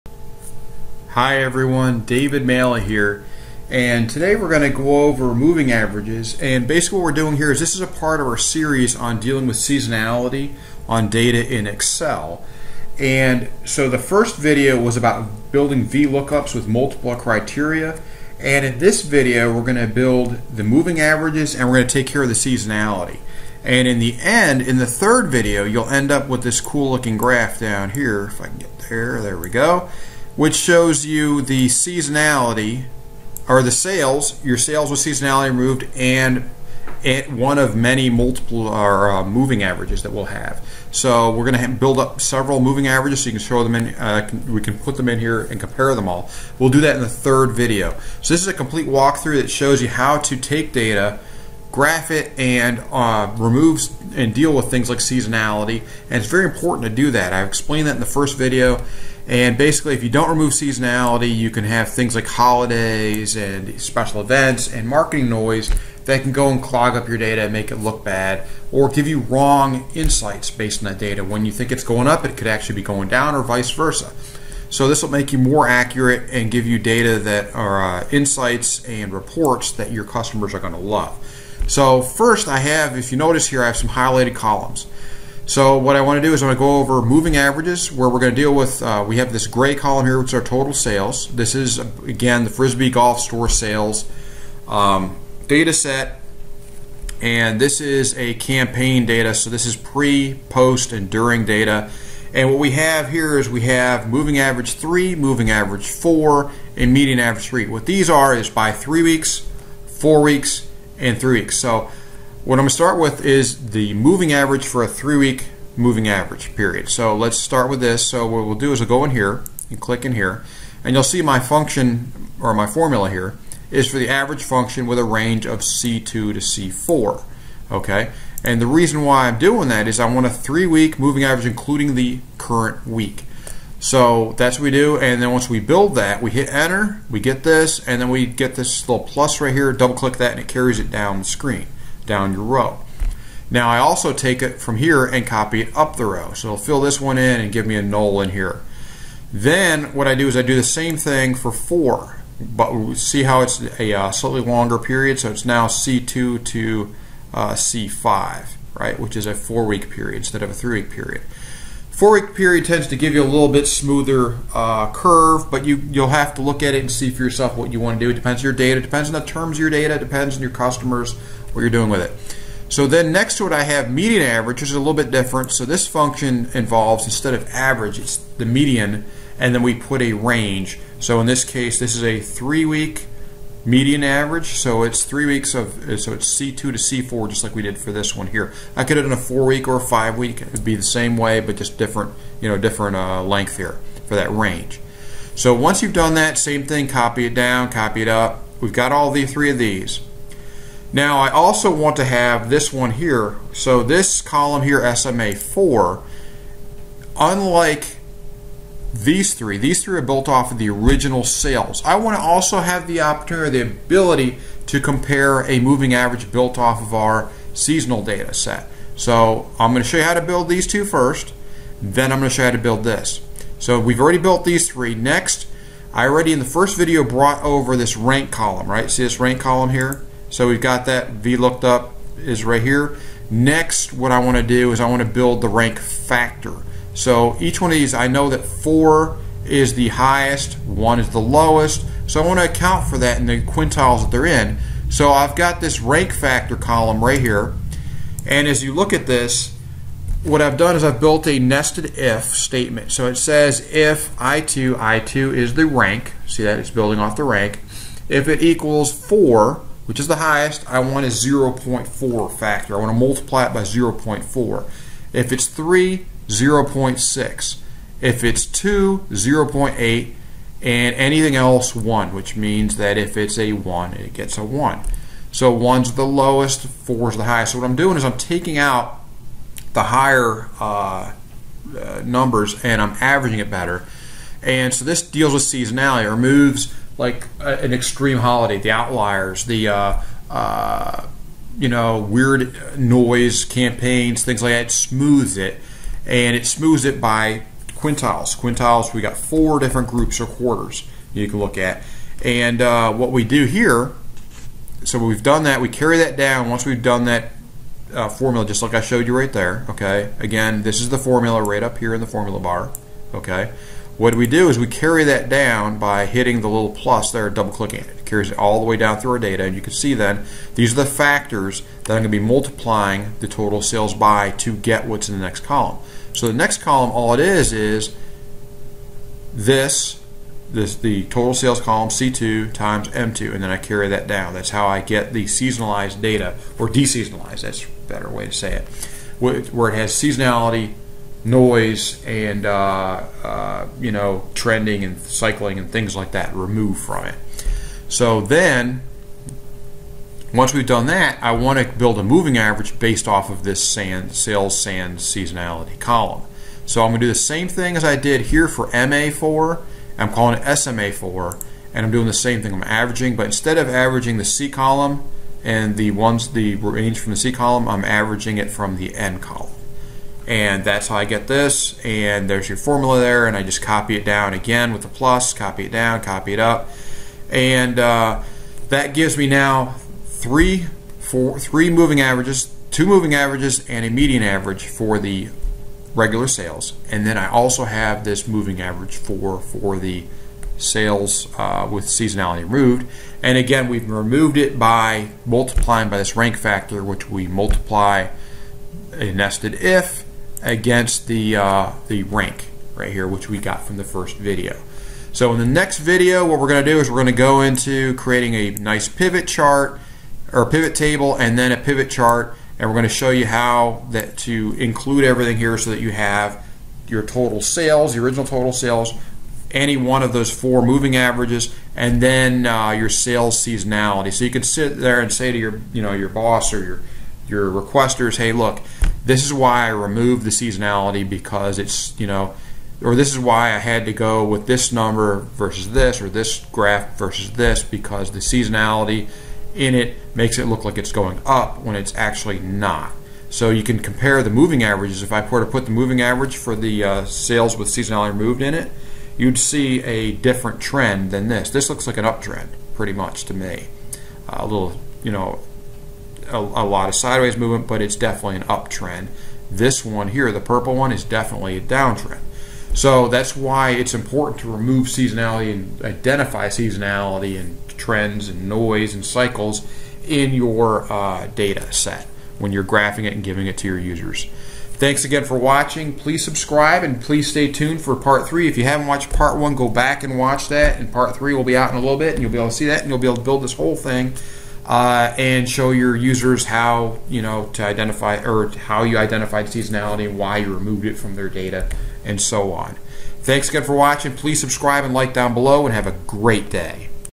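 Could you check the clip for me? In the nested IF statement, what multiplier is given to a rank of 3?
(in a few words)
0.6.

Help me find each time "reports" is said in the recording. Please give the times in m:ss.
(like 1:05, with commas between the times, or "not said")
1:19.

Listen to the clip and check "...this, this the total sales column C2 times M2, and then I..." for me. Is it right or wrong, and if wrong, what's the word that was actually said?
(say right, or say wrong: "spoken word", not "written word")
right.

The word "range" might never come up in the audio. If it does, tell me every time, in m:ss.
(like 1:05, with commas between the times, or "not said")
2:05, 3:00, 3:14, 6:06.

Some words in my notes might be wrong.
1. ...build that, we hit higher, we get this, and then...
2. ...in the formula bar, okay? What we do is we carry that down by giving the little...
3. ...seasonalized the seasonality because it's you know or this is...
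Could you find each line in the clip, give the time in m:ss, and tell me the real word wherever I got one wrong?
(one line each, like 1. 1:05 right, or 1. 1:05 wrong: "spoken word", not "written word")
1. 2:15 wrong: "enter", not "higher"
2. 5:11 wrong: "hitting", not "giving"
3. 7:09 wrong: "removed", not "seasonalized".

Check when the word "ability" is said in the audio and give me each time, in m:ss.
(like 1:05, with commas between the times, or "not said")
3:33.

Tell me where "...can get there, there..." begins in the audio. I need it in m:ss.
0:28.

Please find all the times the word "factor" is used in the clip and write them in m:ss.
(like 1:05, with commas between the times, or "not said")
3:55, 4:06, 4:22, 5:20, 6:36.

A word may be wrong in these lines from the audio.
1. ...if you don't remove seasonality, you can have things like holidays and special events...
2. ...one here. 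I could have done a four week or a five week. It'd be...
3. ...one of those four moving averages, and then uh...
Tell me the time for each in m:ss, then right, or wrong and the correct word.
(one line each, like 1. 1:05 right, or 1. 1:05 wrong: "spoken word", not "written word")
1. 0:59 right
2. 3:08 right
3. 6:59 right.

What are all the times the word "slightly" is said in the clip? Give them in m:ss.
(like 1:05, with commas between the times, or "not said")
2:34.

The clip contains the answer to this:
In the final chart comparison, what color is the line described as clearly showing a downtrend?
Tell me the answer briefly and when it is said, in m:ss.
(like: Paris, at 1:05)
purple, at 7:40.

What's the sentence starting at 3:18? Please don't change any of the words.
We've got all the three of these.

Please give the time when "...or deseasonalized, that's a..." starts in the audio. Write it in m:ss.
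5:36.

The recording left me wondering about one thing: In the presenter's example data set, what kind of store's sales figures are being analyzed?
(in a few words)
Frisbee Golf Store.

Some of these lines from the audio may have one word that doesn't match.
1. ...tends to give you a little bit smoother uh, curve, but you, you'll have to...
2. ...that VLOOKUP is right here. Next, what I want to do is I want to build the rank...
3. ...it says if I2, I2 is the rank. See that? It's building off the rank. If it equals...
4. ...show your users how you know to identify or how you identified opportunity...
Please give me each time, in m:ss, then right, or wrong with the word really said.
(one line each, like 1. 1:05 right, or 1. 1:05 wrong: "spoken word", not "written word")
1. 2:42 right
2. 3:50 right
3. 4:13 right
4. 8:05 wrong: "seasonality", not "opportunity".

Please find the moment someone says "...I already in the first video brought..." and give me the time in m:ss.
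3:45.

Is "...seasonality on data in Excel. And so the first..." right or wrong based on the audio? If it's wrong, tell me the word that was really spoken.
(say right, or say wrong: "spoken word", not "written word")
right.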